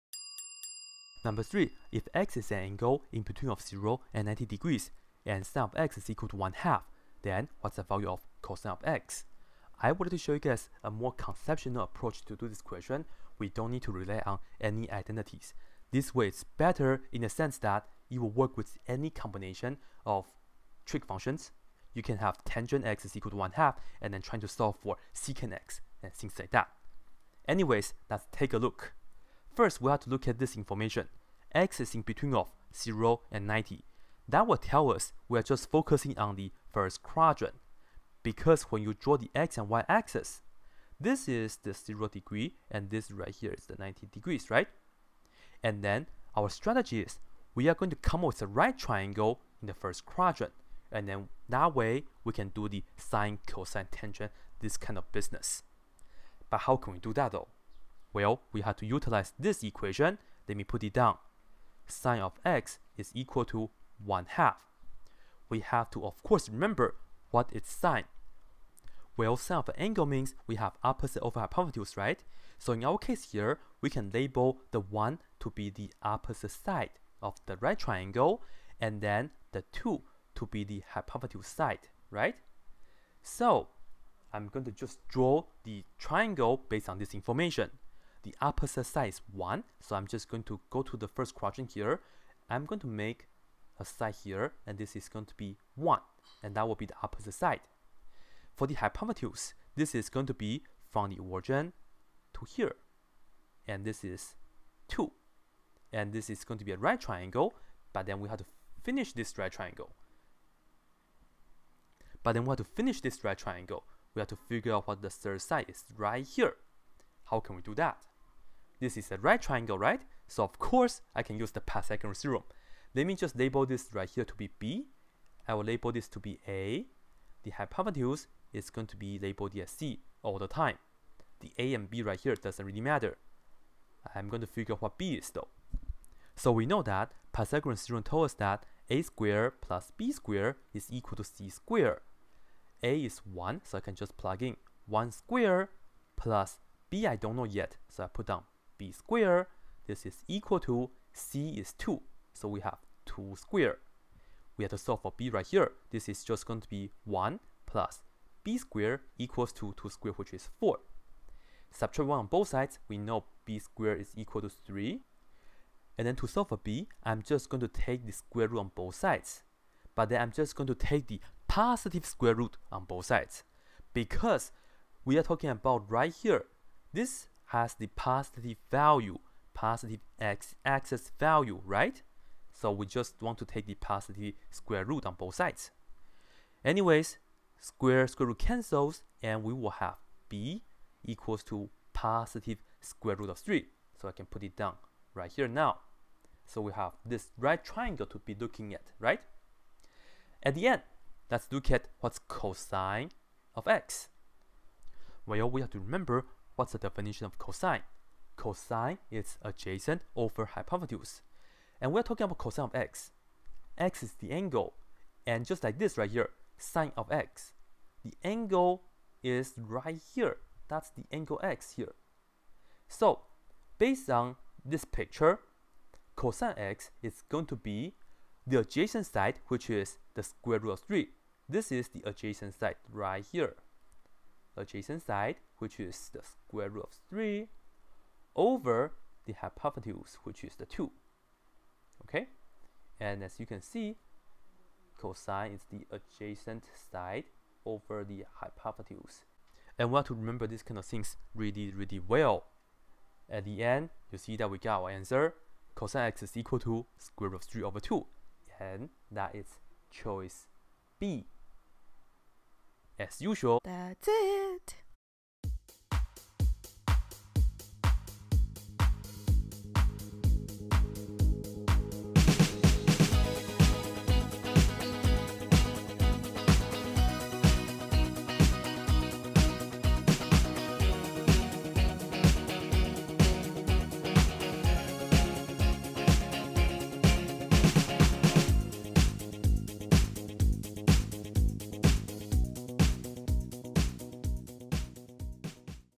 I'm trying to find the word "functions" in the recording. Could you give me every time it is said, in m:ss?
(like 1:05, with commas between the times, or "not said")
0:21.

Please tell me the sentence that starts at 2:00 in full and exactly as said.
So of course, I can use the Pythagorean theorem.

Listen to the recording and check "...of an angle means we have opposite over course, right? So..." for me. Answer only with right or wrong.
wrong.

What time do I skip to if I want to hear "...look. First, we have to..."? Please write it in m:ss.
0:28.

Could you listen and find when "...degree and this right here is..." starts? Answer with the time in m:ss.
0:42.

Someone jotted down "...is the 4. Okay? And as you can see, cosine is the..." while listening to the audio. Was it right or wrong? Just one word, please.
wrong.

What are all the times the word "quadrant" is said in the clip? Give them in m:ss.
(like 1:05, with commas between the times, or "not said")
0:37, 0:50, 1:31.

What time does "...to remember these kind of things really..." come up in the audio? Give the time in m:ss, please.
4:10.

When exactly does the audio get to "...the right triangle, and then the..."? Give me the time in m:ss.
1:17.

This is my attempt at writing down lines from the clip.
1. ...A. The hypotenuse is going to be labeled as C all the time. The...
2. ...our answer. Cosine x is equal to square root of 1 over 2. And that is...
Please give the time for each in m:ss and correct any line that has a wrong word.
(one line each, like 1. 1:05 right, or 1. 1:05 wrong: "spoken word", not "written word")
1. 2:06 right
2. 4:14 wrong: "3", not "1".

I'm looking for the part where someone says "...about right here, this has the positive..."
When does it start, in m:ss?
2:55.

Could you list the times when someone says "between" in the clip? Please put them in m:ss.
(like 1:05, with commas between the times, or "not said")
0:03, 0:32.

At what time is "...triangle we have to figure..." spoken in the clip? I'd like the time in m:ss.
1:53.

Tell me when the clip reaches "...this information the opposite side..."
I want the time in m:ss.
1:26.